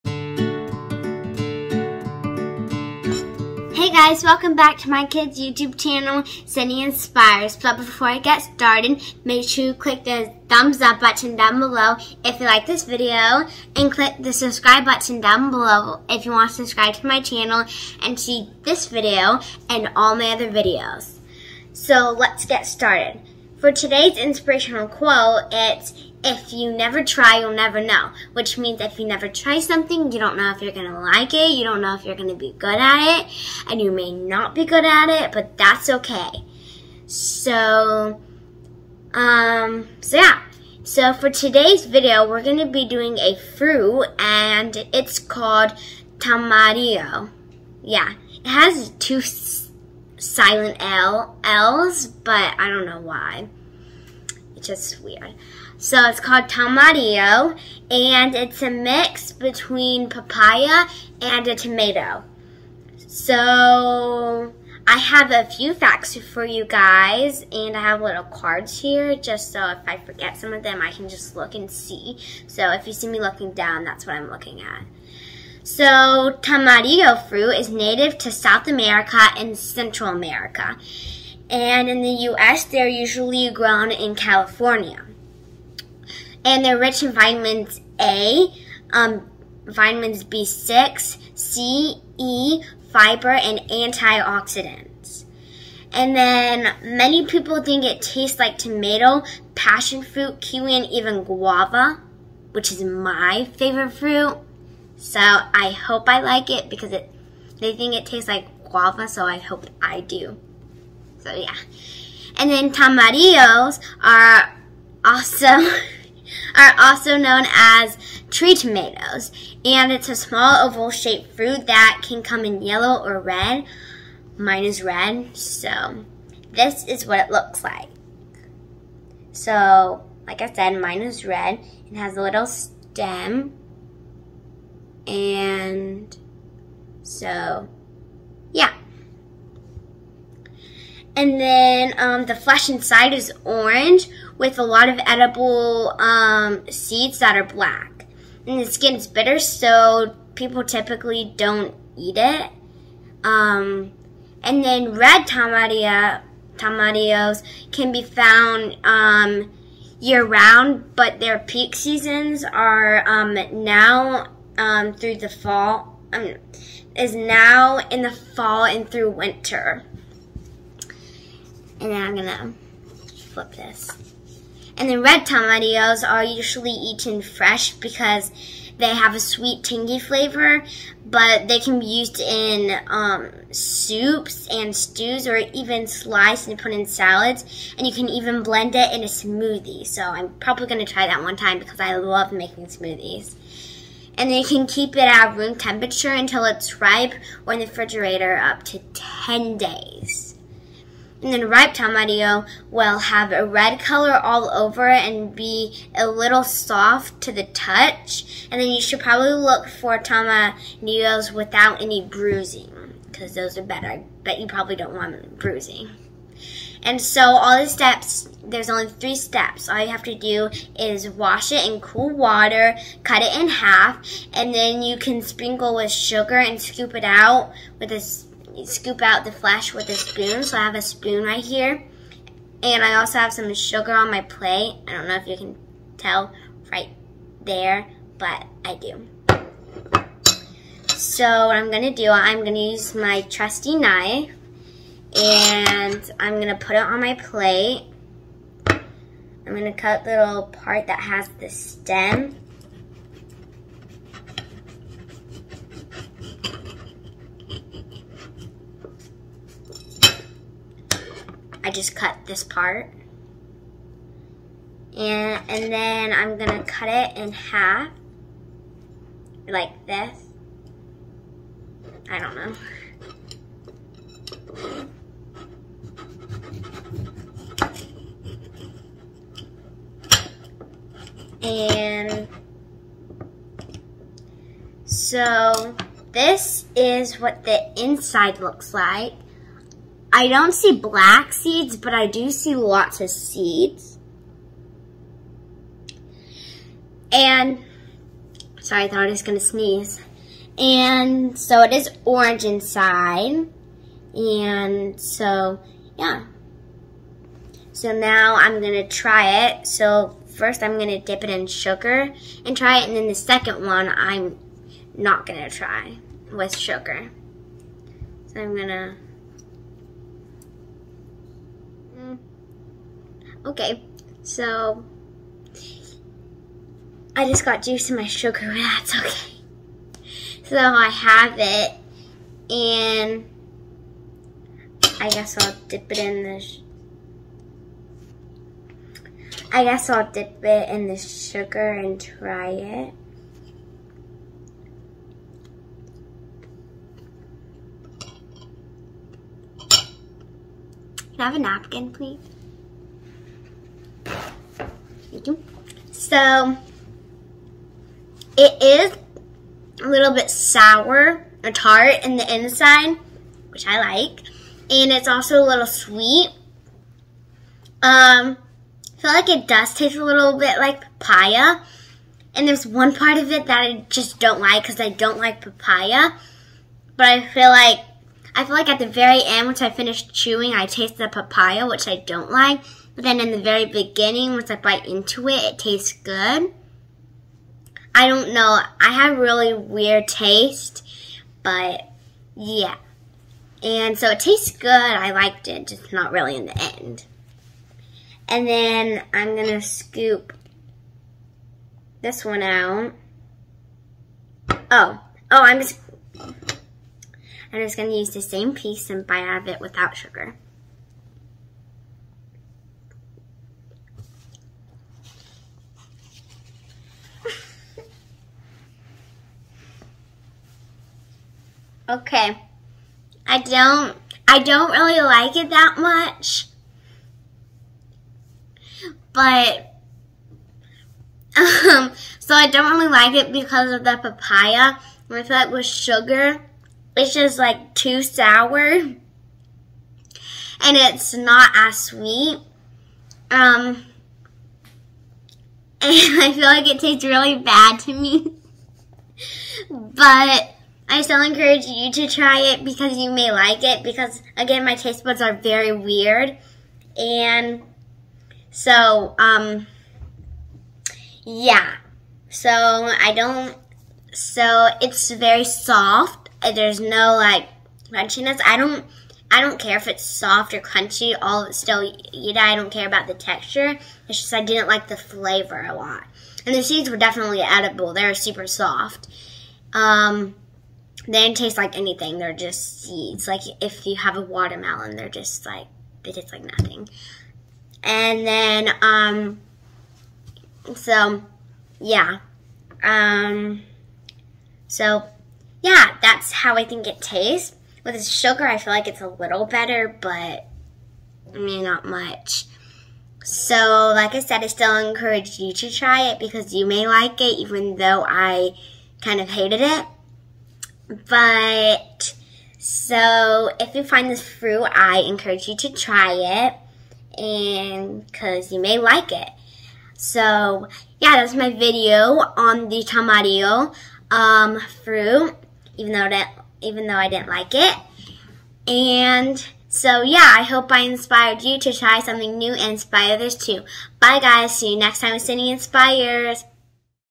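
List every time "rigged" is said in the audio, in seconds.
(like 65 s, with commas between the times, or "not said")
not said.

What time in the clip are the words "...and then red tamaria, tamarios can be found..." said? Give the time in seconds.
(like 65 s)
154 s.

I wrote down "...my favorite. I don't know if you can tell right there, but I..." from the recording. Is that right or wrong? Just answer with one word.
wrong.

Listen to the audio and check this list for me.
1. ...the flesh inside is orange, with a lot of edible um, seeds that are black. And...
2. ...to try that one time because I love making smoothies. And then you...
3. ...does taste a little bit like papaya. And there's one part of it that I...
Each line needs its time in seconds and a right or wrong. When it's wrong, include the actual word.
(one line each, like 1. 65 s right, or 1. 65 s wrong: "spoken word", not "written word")
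1. 142 s right
2. 190 s right
3. 369 s right.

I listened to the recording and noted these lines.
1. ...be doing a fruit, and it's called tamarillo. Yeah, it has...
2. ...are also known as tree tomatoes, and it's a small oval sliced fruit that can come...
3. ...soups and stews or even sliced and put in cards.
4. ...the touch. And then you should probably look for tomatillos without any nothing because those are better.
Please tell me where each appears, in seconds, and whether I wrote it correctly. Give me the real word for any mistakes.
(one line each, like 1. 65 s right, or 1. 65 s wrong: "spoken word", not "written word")
1. 42 s right
2. 116 s wrong: "shaped", not "sliced"
3. 183 s wrong: "salads", not "cards"
4. 207 s wrong: "bruising", not "nothing".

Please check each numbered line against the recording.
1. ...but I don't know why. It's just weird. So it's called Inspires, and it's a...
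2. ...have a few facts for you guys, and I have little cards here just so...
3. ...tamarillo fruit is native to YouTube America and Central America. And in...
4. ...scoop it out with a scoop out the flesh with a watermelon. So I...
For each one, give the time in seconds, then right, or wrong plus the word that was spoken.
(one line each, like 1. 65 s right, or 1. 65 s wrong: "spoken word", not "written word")
1. 52 s wrong: "Tamario", not "Inspires"
2. 64 s right
3. 76 s wrong: "South", not "YouTube"
4. 226 s wrong: "spoon", not "watermelon".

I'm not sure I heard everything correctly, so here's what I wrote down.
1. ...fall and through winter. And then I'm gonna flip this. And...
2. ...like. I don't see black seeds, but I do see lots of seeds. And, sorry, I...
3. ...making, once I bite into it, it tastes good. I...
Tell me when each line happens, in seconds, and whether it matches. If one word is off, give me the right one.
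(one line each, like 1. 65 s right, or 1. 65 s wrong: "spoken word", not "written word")
1. 168 s right
2. 288 s right
3. 383 s wrong: "beginning", not "making".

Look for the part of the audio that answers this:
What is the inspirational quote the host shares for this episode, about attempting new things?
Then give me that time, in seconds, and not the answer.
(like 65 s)
26 s.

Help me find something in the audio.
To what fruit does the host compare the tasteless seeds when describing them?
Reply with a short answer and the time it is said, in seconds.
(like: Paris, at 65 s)
Watermelon, at 484 s.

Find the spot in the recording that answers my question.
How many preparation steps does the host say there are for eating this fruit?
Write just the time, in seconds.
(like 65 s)
218 s.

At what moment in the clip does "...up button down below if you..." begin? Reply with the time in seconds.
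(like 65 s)
10 s.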